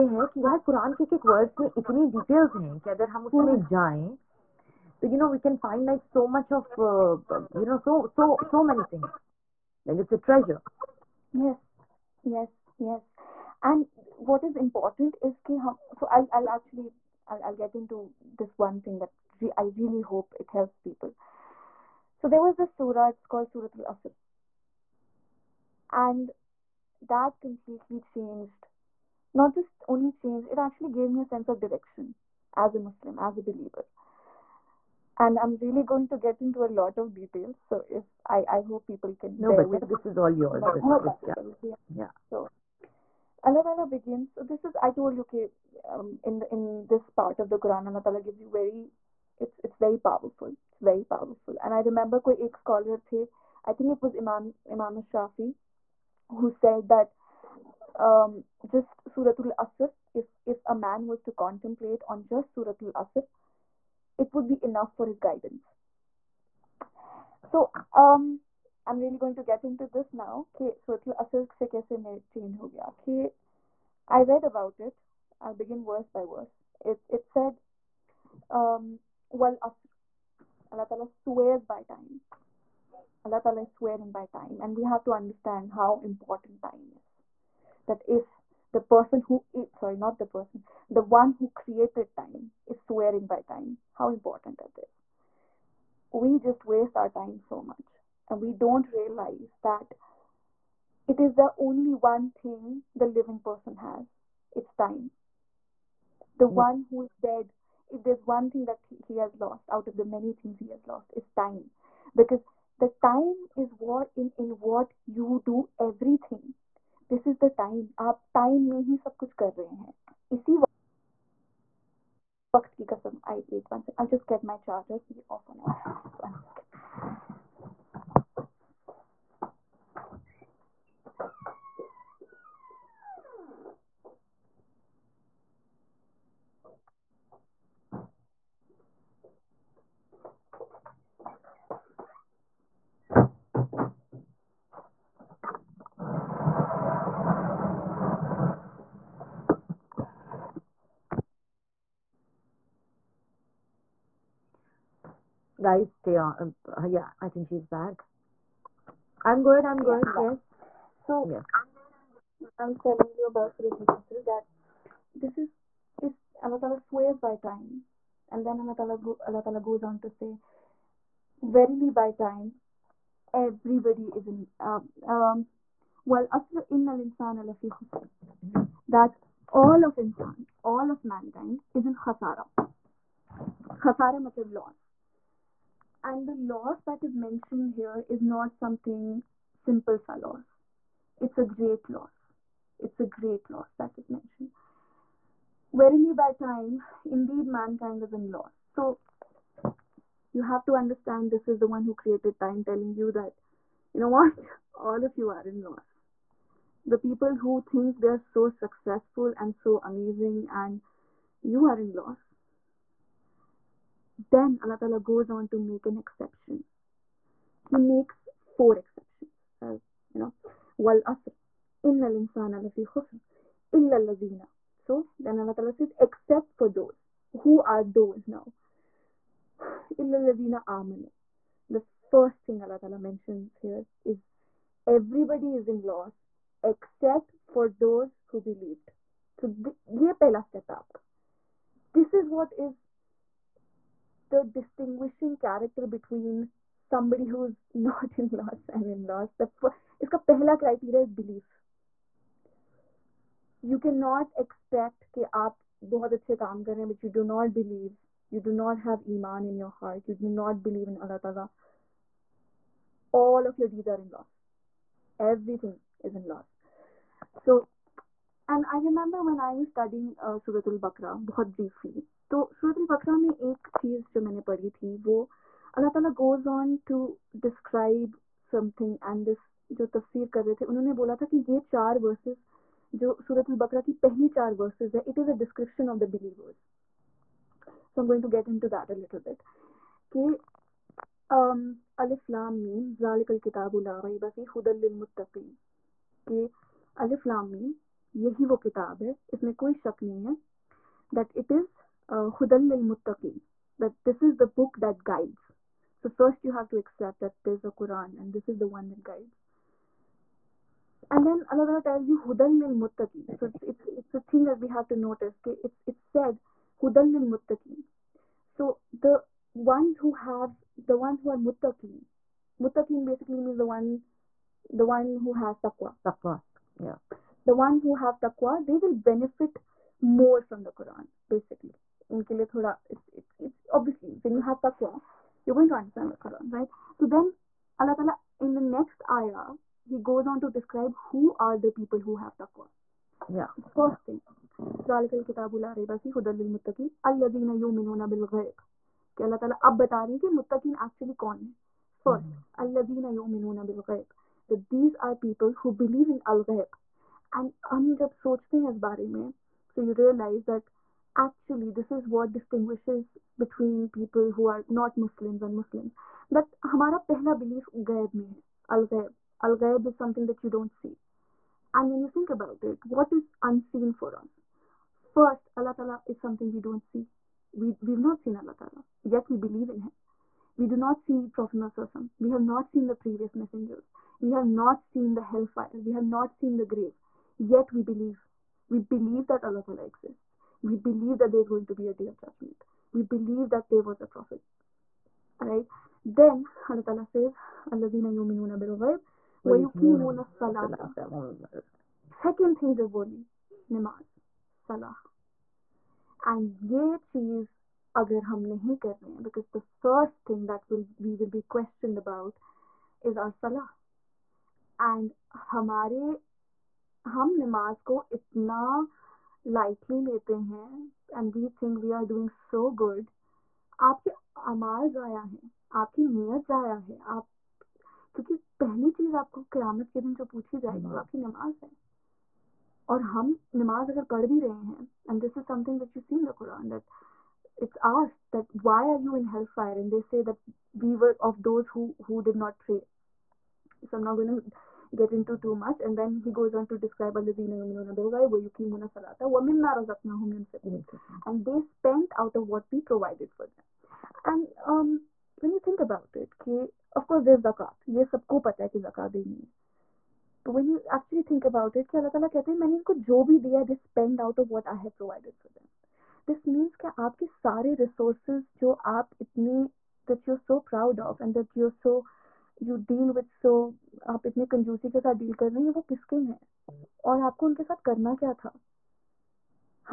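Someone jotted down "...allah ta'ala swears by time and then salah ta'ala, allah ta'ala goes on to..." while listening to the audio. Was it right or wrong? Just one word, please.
wrong.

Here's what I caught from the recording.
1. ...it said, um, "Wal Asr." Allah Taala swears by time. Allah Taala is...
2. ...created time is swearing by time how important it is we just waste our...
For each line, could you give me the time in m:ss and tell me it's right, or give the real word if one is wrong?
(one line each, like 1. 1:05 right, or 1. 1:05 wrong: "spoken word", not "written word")
1. 1:17 right
2. 1:31 right.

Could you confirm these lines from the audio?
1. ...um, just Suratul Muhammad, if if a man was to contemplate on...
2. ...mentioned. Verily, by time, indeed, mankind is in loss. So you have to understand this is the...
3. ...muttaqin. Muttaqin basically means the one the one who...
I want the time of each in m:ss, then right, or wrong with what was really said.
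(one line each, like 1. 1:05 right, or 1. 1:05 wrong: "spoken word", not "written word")
1. 0:57 wrong: "Asr", not "Muhammad"
2. 3:14 right
3. 5:21 right.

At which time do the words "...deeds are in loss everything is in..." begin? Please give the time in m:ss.
4:23.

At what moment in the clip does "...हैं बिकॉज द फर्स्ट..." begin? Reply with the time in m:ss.
6:49.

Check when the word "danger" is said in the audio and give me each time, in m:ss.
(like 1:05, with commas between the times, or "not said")
not said.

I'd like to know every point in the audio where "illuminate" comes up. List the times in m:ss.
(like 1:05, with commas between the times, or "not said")
not said.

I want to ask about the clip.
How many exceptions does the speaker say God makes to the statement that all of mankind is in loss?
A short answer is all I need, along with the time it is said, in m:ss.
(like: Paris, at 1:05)
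4, at 3:38.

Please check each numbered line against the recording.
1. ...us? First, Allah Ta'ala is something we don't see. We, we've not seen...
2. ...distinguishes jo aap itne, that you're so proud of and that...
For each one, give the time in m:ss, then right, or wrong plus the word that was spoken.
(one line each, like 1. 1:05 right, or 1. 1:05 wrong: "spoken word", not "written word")
1. 6:14 right
2. 7:47 wrong: "resources", not "distinguishes".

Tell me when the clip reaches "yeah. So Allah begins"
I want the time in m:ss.
0:41.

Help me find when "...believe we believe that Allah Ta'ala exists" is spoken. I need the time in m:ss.
6:27.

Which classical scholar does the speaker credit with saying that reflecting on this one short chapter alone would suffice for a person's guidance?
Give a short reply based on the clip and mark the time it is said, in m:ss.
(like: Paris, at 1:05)
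Imam Shafi, at 0:54.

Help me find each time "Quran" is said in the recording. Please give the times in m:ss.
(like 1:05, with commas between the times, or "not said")
0:47, 5:07, 5:30.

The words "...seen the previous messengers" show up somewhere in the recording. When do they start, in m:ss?
6:22.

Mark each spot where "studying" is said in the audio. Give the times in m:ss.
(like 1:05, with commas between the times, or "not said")
4:29.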